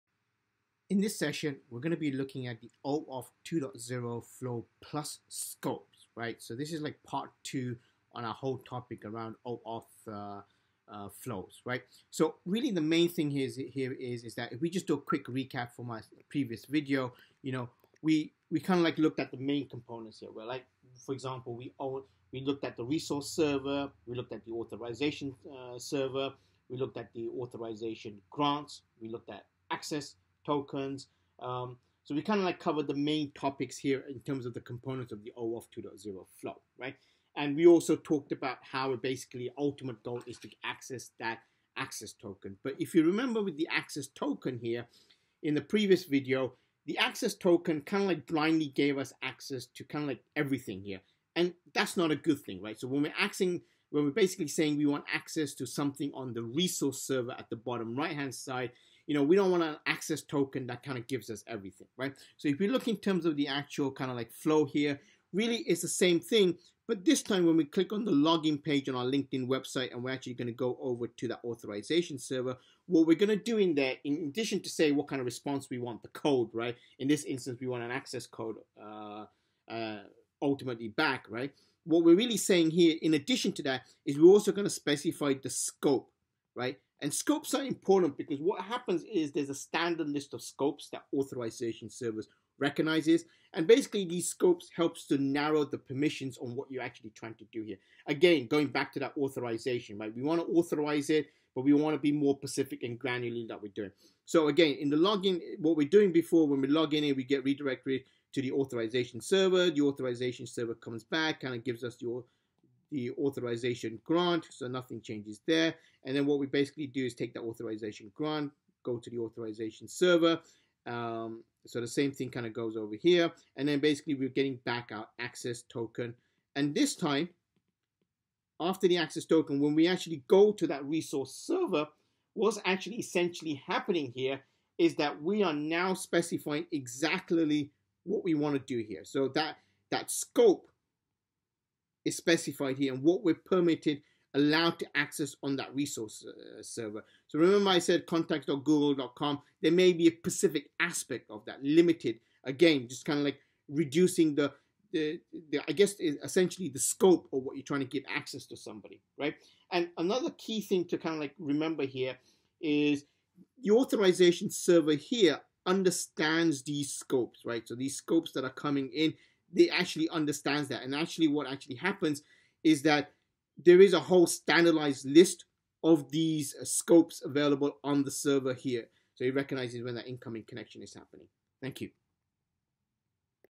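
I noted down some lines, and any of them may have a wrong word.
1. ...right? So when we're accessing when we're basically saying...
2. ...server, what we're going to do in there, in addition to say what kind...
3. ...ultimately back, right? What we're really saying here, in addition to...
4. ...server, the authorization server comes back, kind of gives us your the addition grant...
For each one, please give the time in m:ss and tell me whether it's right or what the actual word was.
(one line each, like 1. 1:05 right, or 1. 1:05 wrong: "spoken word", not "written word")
1. 0:52 right
2. 1:12 right
3. 1:20 right
4. 1:49 wrong: "authorization", not "addition".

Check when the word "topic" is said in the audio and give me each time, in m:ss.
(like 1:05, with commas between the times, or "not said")
0:08, 0:33.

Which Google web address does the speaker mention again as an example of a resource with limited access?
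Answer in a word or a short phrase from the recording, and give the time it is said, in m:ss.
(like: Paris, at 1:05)
contact.google.com, at 2:28.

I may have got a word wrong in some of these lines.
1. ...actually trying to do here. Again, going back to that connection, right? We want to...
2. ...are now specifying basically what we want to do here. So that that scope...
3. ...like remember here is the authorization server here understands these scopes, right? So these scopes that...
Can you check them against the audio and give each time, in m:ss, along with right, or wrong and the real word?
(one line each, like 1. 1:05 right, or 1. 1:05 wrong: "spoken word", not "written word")
1. 1:36 wrong: "authorization", not "connection"
2. 2:15 wrong: "exactly", not "basically"
3. 2:41 right.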